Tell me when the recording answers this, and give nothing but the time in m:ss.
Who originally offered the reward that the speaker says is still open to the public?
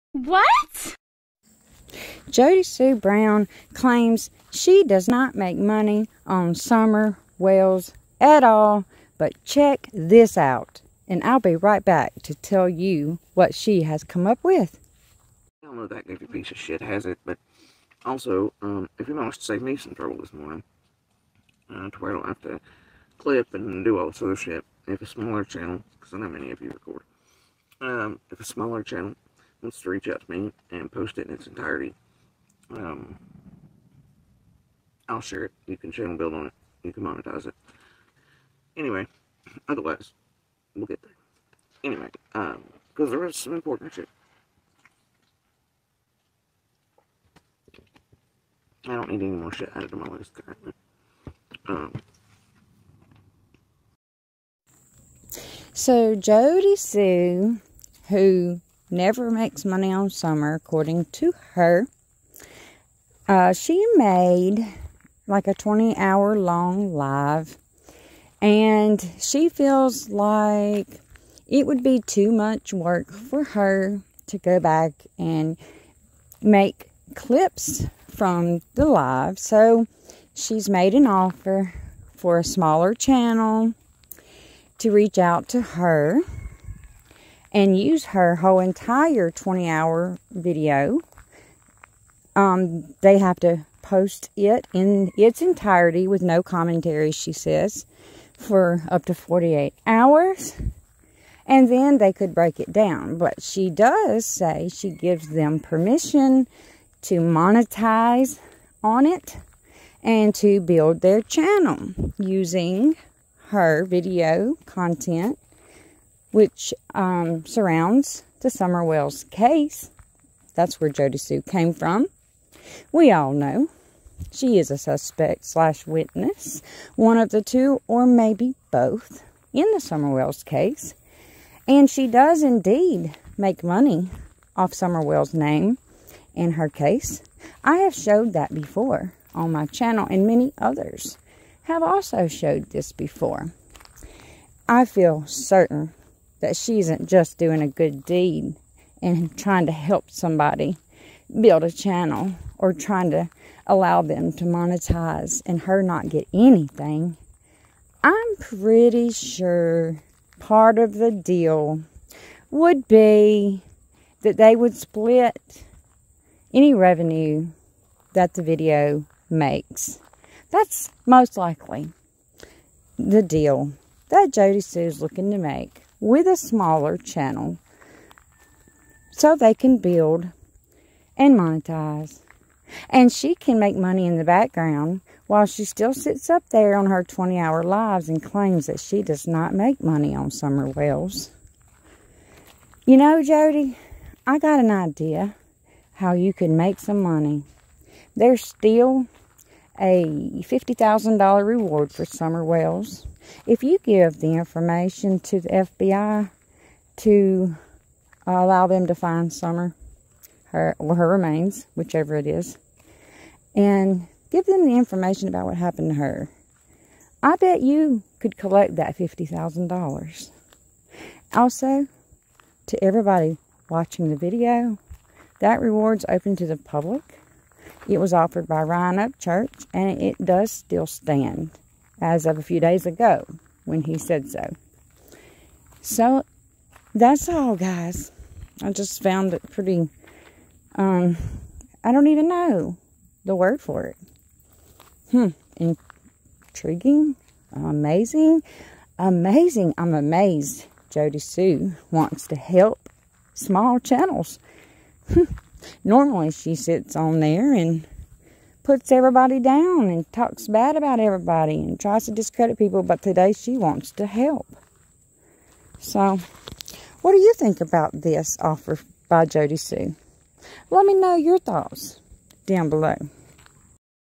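3:48.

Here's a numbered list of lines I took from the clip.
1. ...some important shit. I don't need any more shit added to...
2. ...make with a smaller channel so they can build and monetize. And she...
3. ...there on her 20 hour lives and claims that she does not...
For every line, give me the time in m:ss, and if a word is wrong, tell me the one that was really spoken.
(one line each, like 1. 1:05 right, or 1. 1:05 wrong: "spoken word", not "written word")
1. 0:43 right
2. 2:55 right
3. 3:06 right.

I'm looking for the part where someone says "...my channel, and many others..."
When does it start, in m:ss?
2:19.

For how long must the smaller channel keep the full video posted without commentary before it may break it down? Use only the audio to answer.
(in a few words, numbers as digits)
48 hours.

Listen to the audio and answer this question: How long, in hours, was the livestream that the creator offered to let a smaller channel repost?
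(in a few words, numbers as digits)
20.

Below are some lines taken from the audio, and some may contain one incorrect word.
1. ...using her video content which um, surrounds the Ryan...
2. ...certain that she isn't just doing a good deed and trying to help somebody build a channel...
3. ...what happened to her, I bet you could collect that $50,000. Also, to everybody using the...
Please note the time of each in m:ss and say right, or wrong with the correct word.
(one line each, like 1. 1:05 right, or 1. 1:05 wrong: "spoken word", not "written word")
1. 1:52 wrong: "Summer", not "Ryan"
2. 2:25 right
3. 3:35 wrong: "watching", not "using".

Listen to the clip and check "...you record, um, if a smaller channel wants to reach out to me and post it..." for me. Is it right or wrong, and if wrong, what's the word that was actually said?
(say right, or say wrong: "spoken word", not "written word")
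right.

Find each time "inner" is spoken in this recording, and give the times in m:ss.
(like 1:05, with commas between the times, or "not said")
not said.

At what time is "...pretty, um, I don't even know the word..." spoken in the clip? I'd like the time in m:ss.
3:59.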